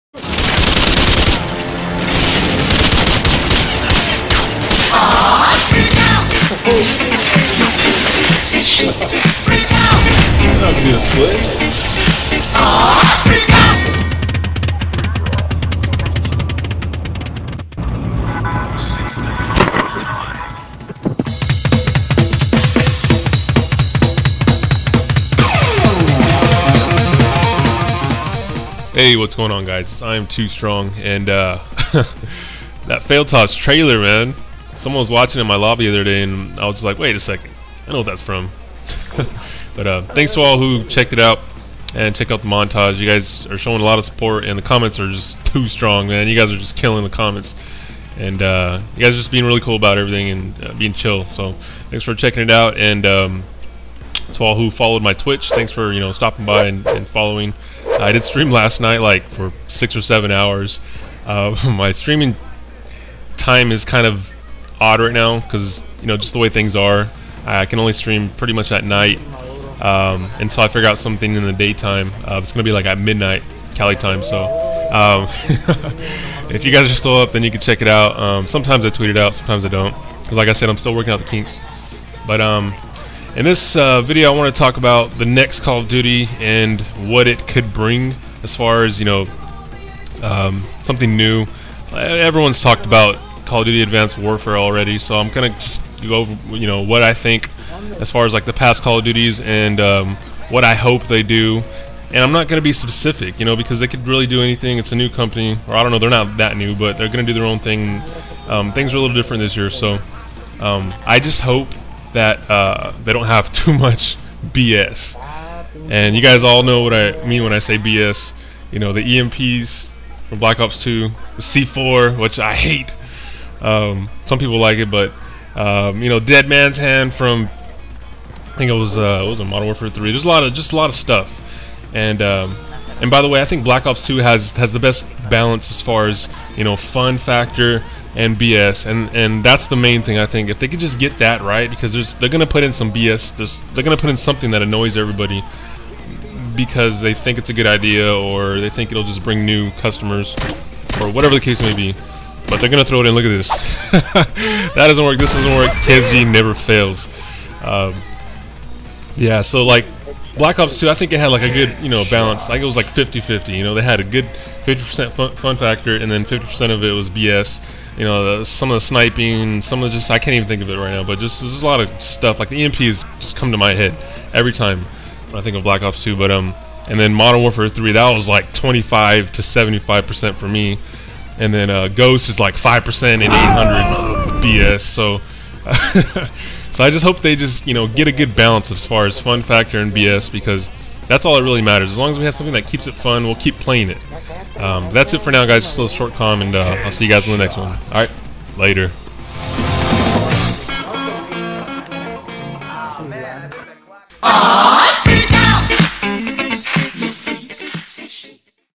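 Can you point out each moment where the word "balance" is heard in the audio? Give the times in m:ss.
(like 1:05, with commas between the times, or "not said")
2:15, 2:42, 3:08.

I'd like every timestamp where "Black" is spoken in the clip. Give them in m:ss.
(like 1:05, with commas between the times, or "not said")
2:00, 2:13, 2:40, 2:55.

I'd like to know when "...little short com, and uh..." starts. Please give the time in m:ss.
3:15.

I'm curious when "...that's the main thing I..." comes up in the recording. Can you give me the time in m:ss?
2:19.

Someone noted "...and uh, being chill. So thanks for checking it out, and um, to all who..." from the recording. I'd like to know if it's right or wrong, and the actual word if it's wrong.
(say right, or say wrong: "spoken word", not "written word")
right.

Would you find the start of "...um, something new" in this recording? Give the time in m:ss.
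1:30.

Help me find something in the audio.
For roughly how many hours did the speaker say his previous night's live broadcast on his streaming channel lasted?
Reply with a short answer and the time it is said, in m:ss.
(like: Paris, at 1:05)
6 or 7 hours, at 0:59.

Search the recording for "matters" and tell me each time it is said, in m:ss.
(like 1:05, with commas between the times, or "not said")
3:11.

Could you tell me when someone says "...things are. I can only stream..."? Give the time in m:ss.
1:06.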